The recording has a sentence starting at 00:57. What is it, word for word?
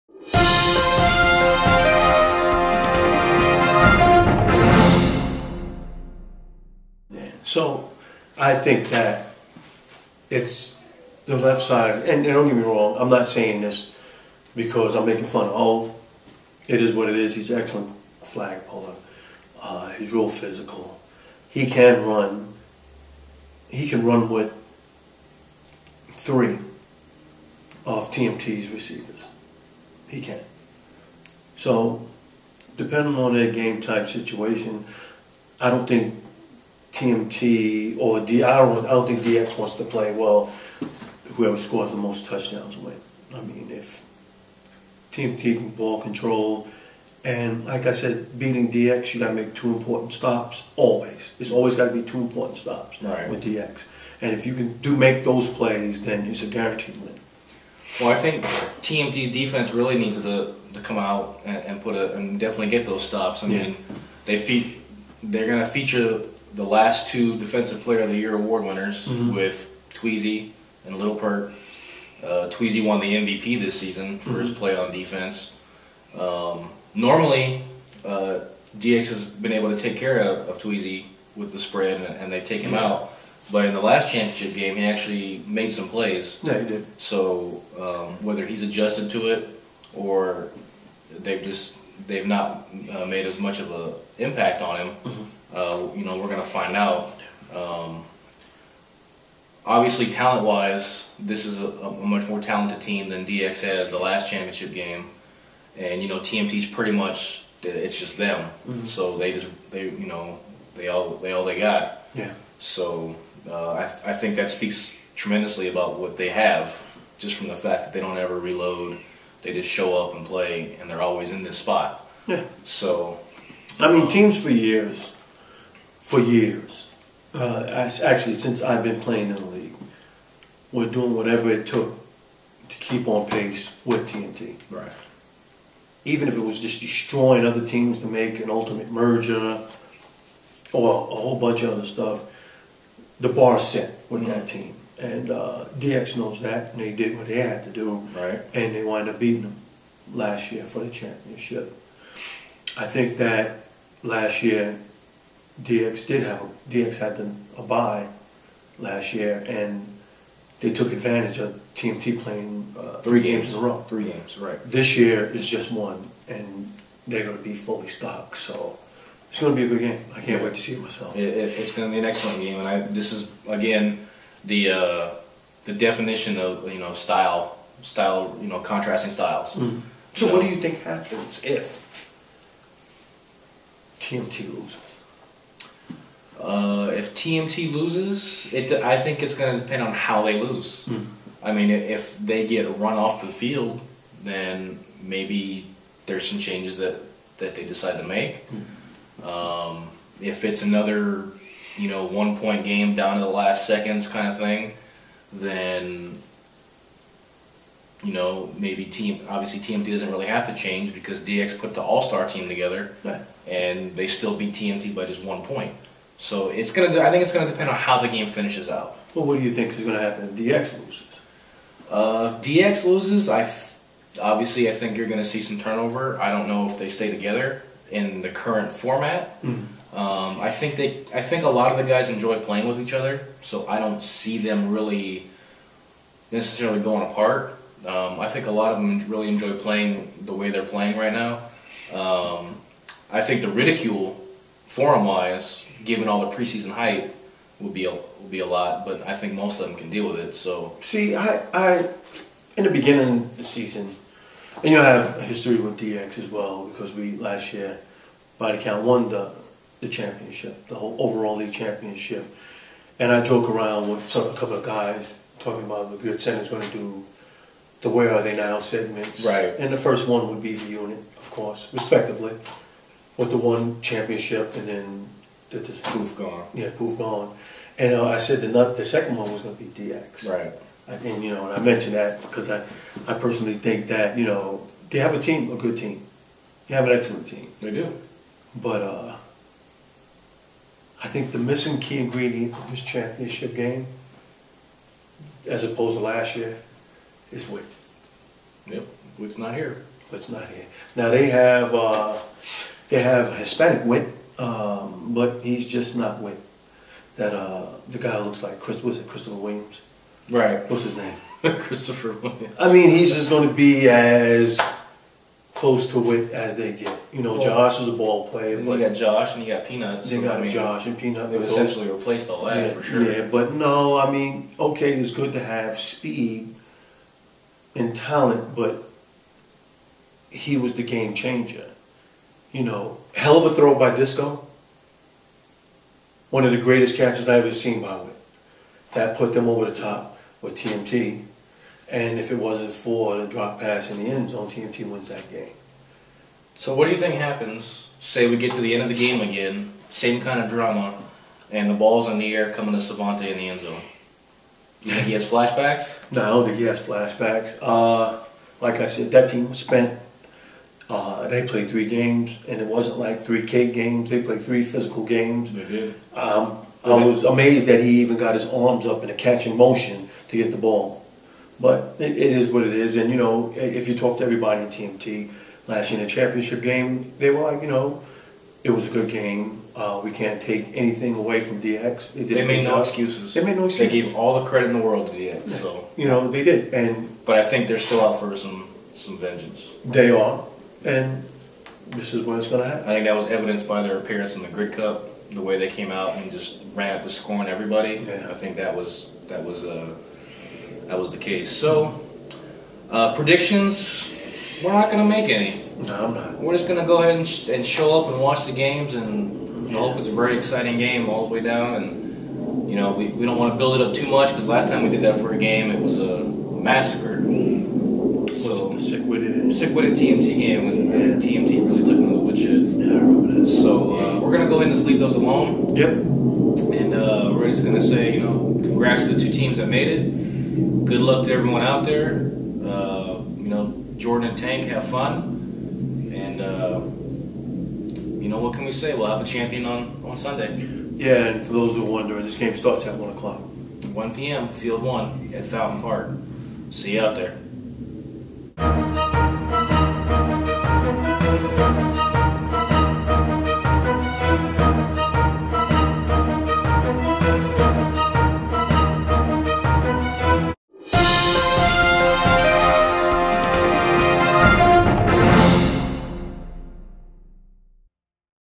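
Well, I think TMT's defense really needs to, to come out and, and put a and definitely get those stops.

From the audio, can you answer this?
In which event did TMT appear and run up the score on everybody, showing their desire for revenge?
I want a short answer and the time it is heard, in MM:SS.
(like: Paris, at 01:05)
Grid Cup, at 06:34.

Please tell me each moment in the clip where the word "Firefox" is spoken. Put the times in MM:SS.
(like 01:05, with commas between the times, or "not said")
not said.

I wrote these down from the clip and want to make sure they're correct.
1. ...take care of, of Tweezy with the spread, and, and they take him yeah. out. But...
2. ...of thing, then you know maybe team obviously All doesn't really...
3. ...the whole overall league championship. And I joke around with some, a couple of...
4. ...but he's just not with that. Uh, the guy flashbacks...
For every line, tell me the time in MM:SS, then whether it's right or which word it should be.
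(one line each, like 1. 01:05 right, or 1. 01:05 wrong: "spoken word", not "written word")
1. 01:19 right
2. 03:24 wrong: "TMT", not "All"
3. 04:20 right
4. 05:05 wrong: "looks", not "flashbacks".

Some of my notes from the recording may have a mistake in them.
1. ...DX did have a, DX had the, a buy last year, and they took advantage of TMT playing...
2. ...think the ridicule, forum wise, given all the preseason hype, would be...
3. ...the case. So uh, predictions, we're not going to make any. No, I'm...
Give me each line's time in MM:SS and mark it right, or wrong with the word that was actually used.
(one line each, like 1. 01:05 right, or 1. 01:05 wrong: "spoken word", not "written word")
1. 02:35 right
2. 04:03 right
3. 06:41 right.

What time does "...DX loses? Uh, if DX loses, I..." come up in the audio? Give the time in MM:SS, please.
03:40.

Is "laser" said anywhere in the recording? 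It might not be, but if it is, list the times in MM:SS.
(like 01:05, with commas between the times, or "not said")
not said.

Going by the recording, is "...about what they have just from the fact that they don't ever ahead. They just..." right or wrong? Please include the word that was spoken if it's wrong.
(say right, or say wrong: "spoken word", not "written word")
wrong: "reload", not "ahead".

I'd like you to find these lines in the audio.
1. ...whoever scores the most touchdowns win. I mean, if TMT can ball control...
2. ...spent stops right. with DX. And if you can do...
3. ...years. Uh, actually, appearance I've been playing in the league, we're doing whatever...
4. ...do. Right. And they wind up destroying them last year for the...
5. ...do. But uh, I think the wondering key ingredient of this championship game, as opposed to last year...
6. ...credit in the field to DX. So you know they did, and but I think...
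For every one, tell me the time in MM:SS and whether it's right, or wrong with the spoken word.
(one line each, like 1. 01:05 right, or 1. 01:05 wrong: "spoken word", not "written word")
1. 00:41 right
2. 00:52 wrong: "important", not "spent"
3. 02:06 wrong: "since", not "appearance"
4. 02:27 wrong: "beating", not "destroying"
5. 04:47 wrong: "missing", not "wondering"
6. 06:24 wrong: "world", not "field".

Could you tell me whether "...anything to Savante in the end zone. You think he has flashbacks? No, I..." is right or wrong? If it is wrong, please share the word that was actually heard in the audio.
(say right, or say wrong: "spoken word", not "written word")
wrong: "coming", not "anything".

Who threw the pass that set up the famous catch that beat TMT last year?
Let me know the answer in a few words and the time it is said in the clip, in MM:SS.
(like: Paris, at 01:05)
Disco, at 05:33.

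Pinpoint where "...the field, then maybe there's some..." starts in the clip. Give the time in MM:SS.
03:13.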